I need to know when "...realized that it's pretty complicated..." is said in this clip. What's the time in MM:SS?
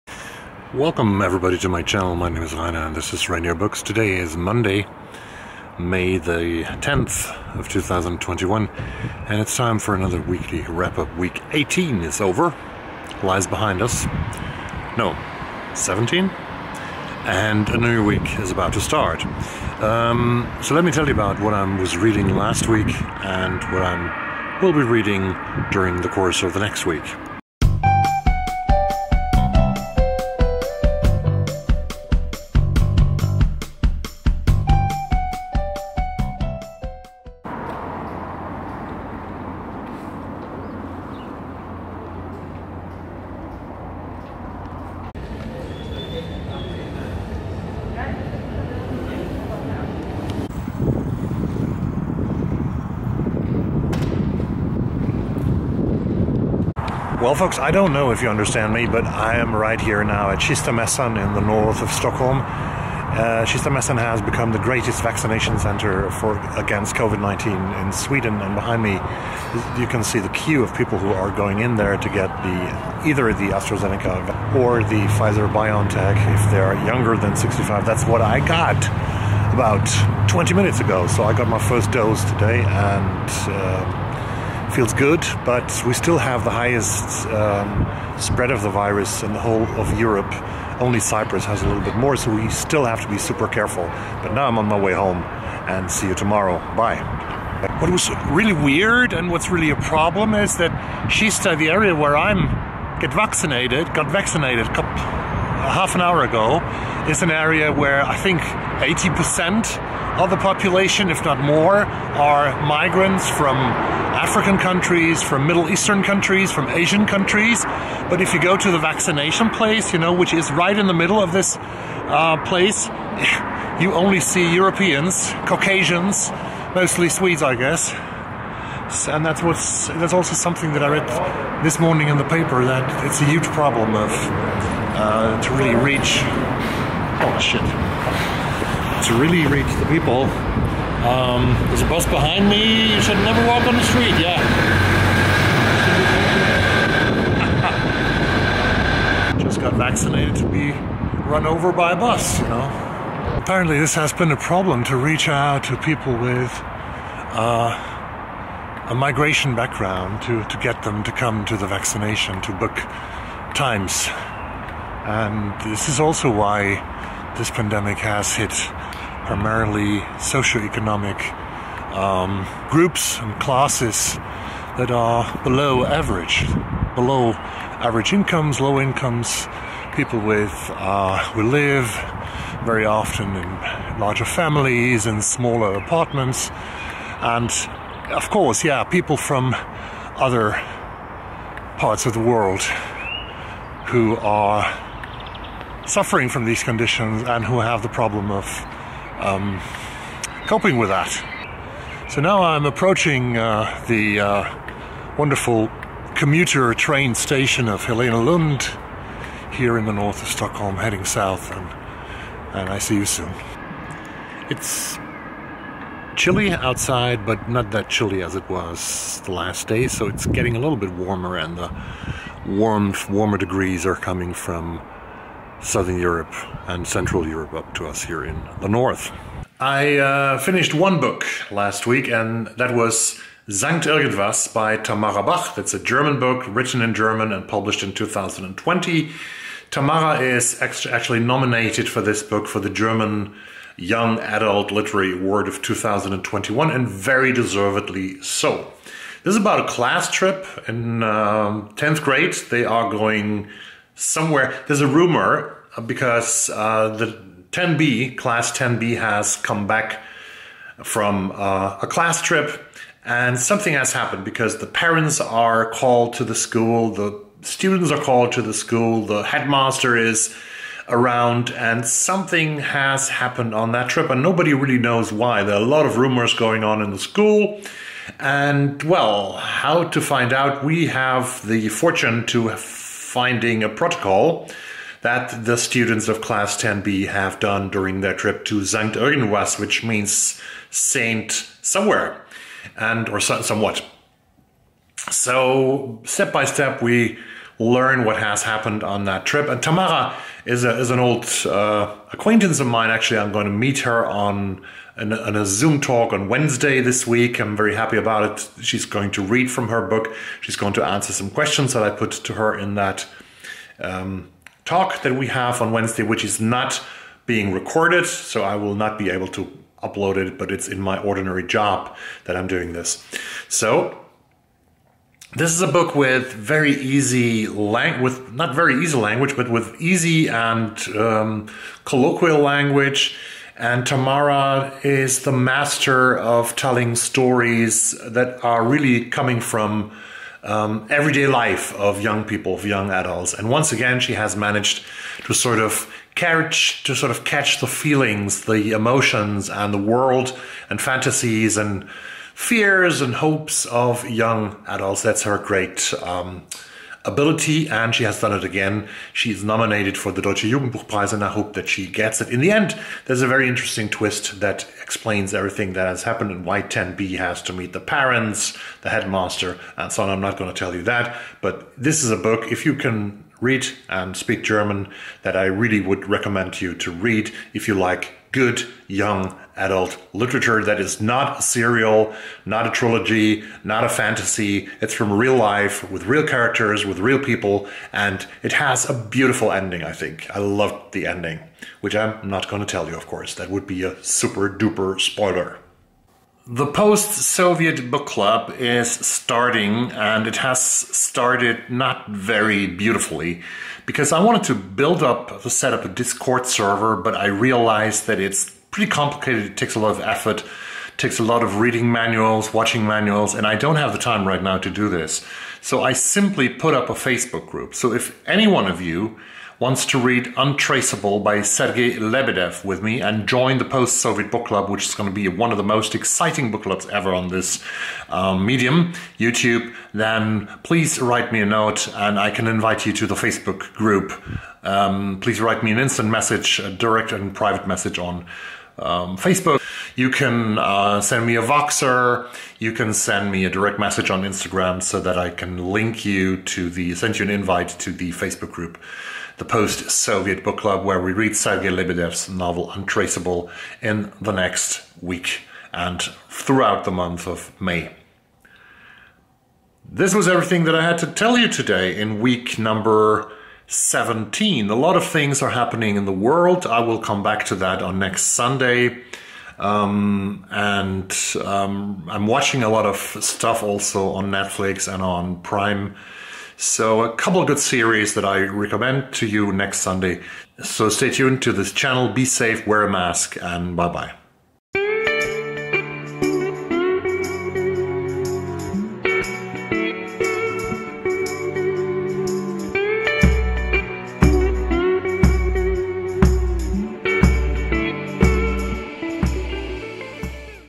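06:47.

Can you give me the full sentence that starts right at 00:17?
And a new week is about to start.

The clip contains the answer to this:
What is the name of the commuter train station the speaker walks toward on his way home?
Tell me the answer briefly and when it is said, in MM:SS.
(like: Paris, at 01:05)
Helenelund, at 03:27.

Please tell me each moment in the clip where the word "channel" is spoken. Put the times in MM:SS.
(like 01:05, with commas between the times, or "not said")
00:01, 08:01.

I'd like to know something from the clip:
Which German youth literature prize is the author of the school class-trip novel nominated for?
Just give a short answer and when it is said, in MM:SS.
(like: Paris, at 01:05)
Deutsche Jugendbuchpreis, at 06:00.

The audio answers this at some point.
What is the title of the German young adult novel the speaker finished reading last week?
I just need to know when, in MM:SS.
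03:53.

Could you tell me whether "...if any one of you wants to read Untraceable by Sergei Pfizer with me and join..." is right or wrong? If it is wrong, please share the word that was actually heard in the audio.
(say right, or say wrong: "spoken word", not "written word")
wrong: "Lebedev", not "Pfizer".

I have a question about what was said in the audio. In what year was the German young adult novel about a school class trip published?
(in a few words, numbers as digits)
2020.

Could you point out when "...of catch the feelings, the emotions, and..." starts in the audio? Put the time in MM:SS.
05:47.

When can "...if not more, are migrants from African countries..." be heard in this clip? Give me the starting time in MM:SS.
01:51.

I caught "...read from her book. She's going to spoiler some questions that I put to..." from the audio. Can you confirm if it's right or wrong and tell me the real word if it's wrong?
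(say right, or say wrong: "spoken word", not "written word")
wrong: "answer", not "spoiler".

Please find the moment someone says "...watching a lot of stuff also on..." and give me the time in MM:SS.
07:52.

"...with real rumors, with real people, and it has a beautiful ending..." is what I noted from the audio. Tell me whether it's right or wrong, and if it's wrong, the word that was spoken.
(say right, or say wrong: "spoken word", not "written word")
wrong: "characters", not "rumors".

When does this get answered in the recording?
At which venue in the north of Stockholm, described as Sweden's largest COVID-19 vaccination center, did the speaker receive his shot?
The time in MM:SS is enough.
01:00.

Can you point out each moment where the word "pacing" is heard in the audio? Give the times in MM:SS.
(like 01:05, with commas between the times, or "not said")
not said.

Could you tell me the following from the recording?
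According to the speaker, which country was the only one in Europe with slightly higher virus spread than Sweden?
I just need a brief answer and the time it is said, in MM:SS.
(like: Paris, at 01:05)
Cyprus, at 01:30.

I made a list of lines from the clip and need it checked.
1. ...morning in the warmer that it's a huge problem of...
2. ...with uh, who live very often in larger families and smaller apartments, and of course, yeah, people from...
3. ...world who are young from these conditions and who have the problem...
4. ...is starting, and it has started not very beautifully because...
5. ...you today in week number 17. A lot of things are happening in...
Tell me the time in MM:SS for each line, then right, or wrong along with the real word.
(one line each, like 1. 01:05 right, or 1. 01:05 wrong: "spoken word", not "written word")
1. 02:11 wrong: "paper", not "warmer"
2. 03:00 right
3. 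03:12 wrong: "suffering", not "young"
4. 06:38 right
5. 07:41 right.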